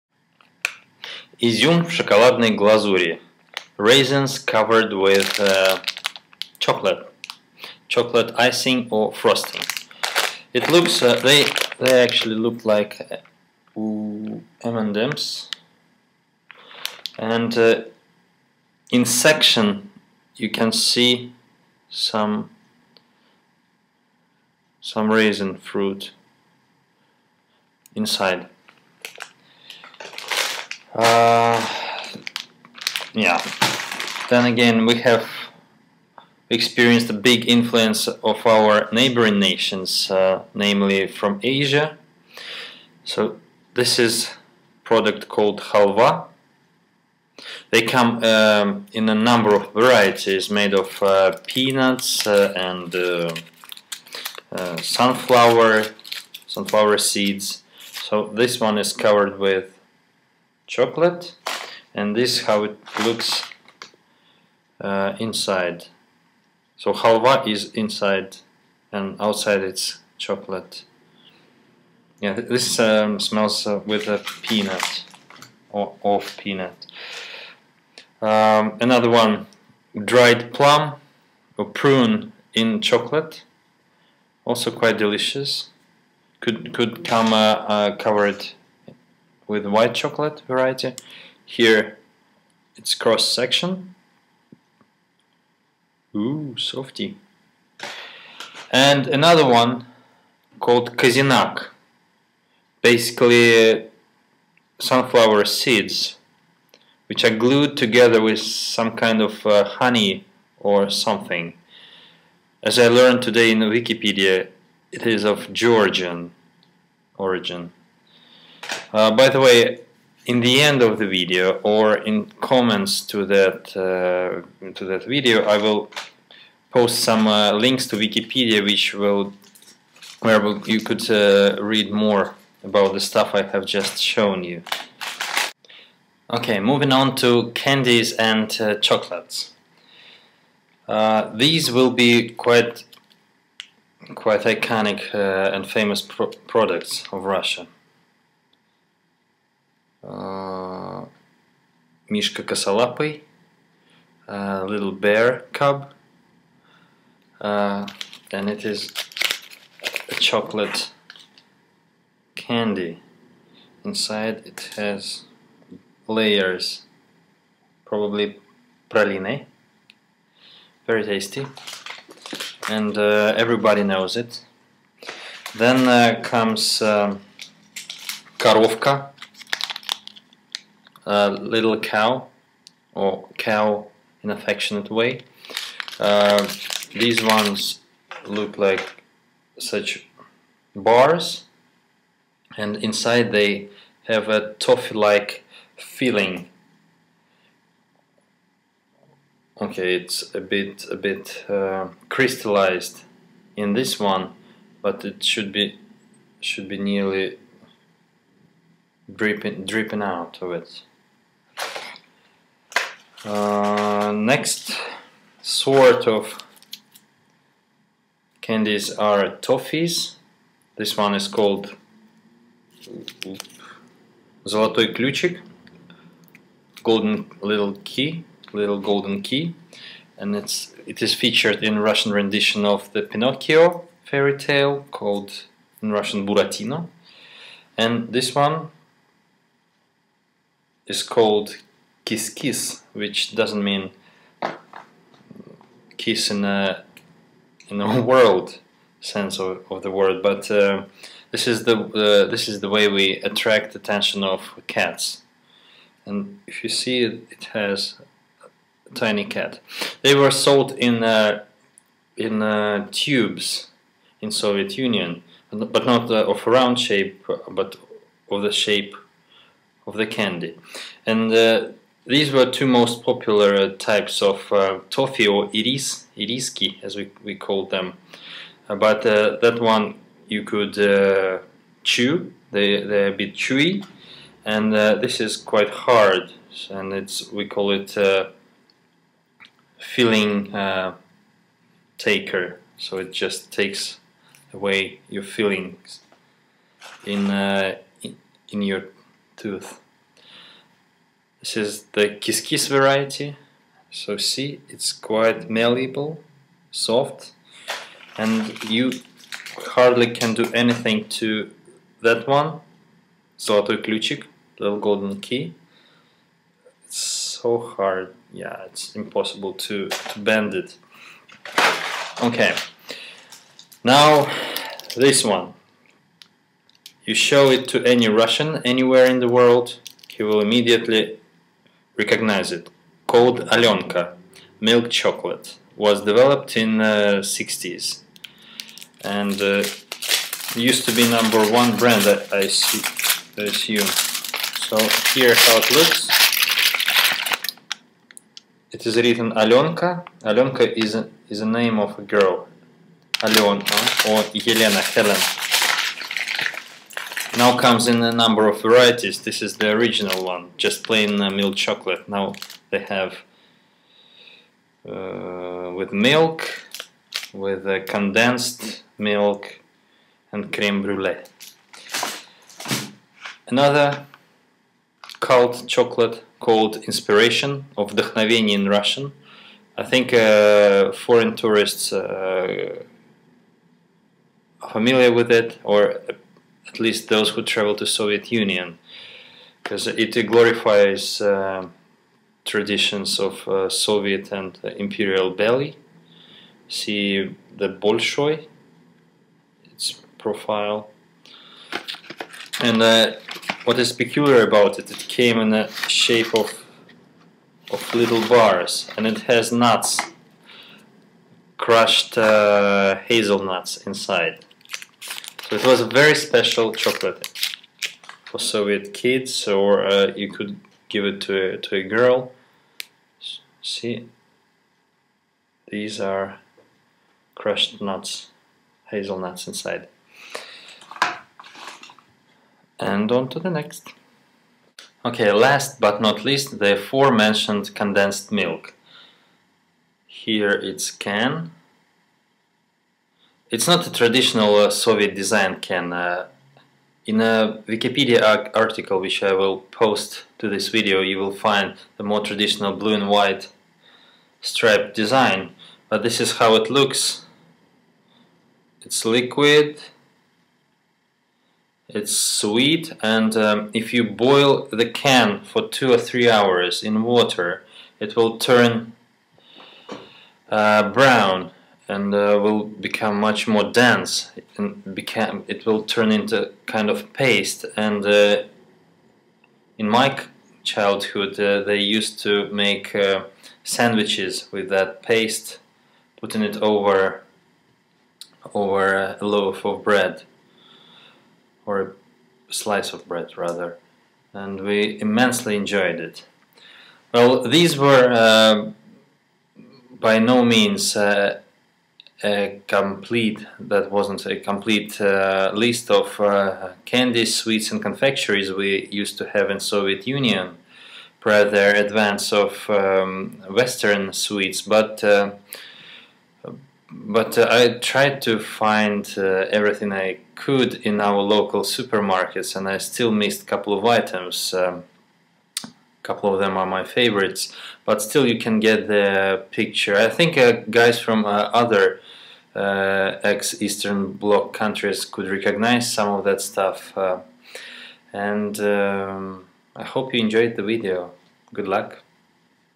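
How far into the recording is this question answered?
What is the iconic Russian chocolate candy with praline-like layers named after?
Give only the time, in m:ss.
2:34.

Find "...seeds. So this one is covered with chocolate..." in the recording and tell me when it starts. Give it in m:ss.
0:56.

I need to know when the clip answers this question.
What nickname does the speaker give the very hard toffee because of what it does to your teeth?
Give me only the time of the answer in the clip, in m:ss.
4:49.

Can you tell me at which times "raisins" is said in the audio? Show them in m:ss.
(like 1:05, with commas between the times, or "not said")
0:03, 0:25.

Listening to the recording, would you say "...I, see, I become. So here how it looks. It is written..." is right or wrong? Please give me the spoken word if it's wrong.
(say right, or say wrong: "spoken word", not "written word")
wrong: "assume", not "become".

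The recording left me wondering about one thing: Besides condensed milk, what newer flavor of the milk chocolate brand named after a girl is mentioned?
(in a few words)
creme brulee.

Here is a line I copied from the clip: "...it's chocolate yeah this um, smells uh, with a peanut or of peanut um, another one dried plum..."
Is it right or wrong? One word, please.
right.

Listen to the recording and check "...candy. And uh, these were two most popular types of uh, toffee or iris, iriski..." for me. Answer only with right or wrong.
right.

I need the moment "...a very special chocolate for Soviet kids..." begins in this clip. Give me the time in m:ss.
6:55.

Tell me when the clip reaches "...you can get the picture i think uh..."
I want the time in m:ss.
8:48.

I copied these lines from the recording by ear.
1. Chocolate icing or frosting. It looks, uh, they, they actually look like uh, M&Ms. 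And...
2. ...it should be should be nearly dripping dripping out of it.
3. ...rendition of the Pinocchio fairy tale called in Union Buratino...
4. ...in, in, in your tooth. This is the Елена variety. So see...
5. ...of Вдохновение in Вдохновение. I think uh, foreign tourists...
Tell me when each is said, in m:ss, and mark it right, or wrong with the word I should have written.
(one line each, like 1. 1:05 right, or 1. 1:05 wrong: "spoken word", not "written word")
1. 0:07 right
2. 3:25 right
3. 3:52 wrong: "Russian", not "Union"
4. 4:57 wrong: "Kiskis", not "Елена"
5. 6:17 wrong: "Russian", not "Вдохновение".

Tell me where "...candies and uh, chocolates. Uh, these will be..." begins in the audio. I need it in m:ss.
2:17.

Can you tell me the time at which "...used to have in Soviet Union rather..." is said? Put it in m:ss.
8:28.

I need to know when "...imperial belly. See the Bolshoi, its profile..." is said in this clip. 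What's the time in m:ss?
6:34.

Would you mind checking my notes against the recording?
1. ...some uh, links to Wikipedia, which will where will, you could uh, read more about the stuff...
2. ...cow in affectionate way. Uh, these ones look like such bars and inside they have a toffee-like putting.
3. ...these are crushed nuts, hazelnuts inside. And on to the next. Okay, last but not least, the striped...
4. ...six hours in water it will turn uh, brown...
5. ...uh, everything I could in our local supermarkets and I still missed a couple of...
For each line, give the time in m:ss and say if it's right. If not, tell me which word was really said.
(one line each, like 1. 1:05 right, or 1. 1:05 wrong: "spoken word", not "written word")
1. 2:06 right
2. 3:03 wrong: "feeling", not "putting"
3. 7:05 wrong: "aforementioned", not "striped"
4. 7:45 wrong: "three", not "six"
5. 8:39 right.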